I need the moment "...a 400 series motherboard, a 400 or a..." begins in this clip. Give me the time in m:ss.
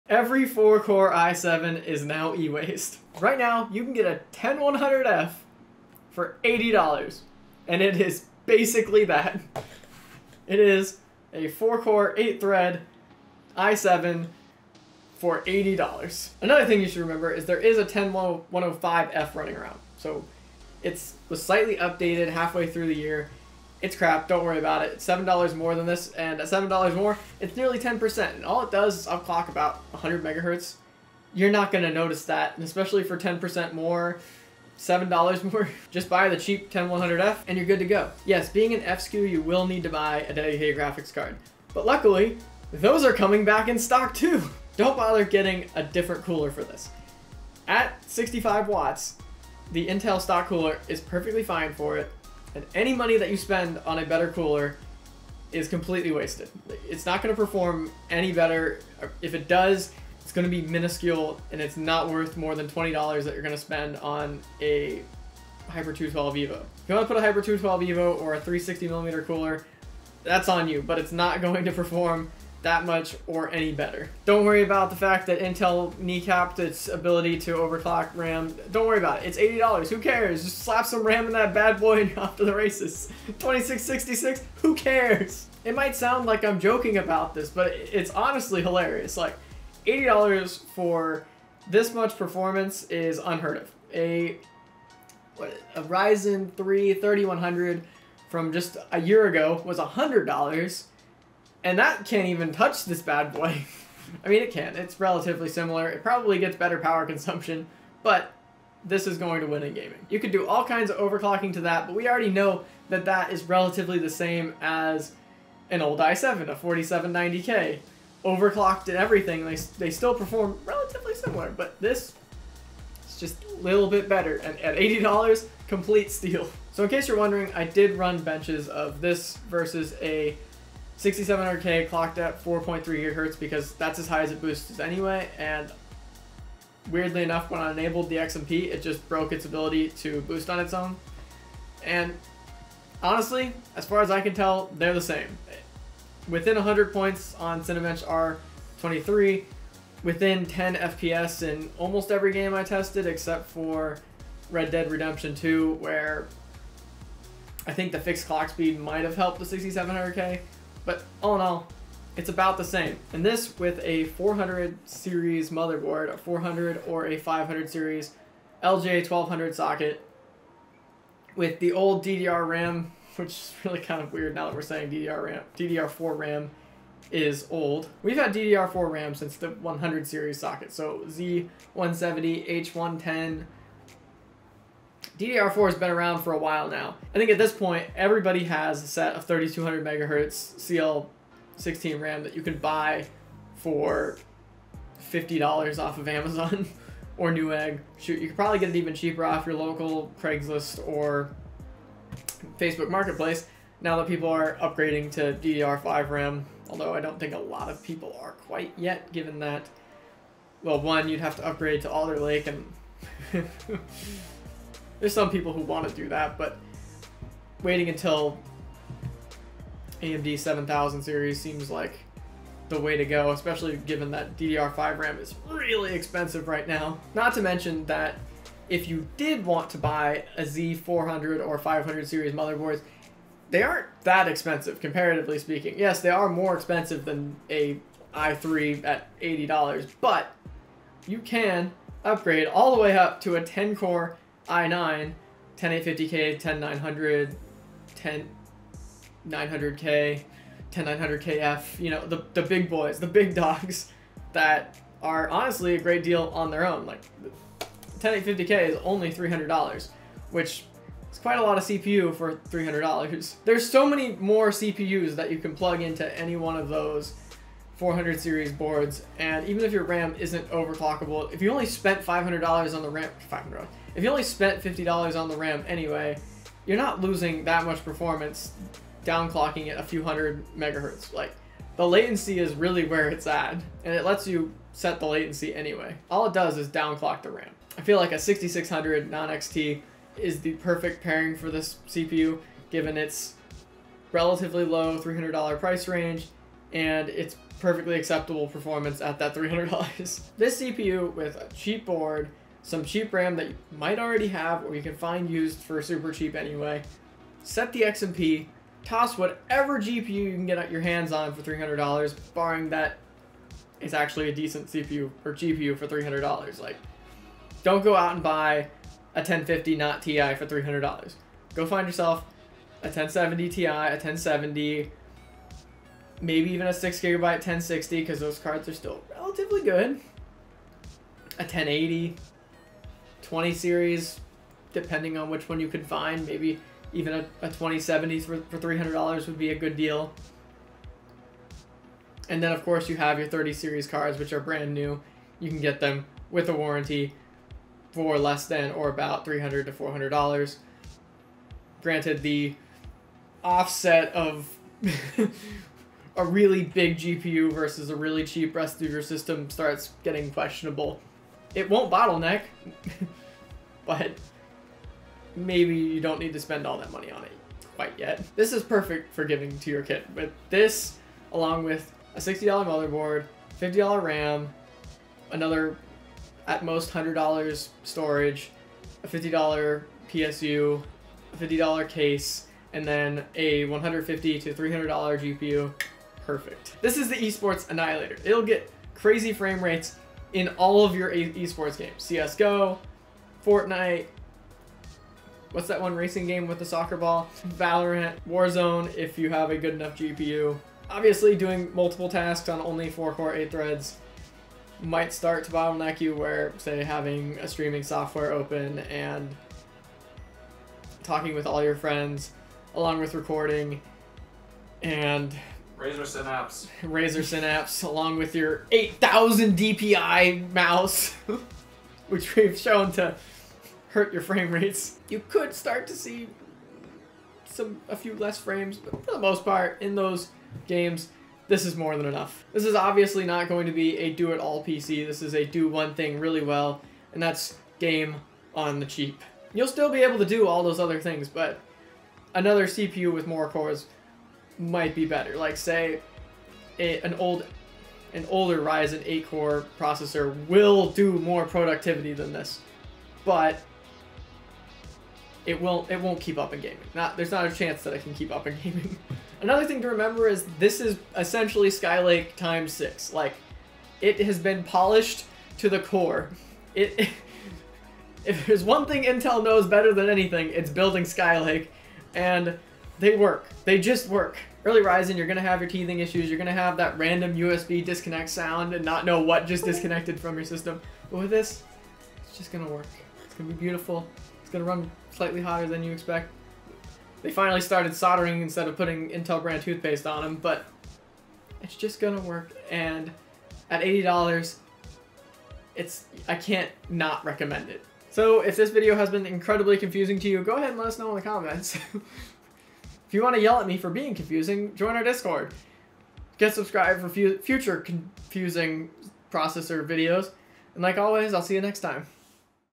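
2:43.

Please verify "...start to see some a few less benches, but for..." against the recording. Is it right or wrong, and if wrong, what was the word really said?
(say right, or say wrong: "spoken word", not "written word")
wrong: "frames", not "benches".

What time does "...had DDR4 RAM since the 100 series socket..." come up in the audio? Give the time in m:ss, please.
2:58.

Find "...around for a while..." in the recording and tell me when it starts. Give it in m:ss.
3:05.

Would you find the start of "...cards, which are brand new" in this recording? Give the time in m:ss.
5:43.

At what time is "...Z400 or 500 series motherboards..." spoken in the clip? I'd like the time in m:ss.
3:50.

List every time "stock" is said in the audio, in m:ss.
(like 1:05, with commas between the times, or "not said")
0:43, 0:50.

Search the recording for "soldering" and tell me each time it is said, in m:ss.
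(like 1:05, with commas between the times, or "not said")
8:07.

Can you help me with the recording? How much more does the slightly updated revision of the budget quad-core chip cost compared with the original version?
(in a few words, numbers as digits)
$7.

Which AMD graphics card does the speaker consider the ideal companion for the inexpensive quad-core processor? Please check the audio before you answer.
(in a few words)
6600 non-XT.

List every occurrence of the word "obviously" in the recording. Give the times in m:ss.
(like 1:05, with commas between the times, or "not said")
6:40, 7:12.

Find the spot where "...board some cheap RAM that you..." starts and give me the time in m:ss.
5:01.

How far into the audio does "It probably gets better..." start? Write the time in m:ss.
1:45.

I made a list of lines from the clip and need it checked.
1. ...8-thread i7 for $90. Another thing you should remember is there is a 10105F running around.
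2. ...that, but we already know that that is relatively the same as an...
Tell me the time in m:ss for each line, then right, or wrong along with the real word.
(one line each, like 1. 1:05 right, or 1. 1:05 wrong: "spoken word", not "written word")
1. 0:12 wrong: "80", not "90"
2. 1:51 right.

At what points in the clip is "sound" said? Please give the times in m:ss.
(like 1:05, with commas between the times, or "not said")
1:25, 7:58.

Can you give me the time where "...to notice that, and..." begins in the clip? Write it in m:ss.
0:31.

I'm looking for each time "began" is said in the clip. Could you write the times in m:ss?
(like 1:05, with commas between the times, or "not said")
not said.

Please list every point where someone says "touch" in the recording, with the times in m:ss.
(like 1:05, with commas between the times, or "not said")
1:42.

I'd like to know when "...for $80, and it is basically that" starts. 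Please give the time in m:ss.
0:06.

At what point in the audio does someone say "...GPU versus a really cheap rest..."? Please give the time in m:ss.
5:56.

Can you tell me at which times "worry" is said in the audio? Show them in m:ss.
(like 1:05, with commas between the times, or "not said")
0:24, 1:14, 1:18.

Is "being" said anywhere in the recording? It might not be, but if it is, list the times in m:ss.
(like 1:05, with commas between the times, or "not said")
0:38, 8:23.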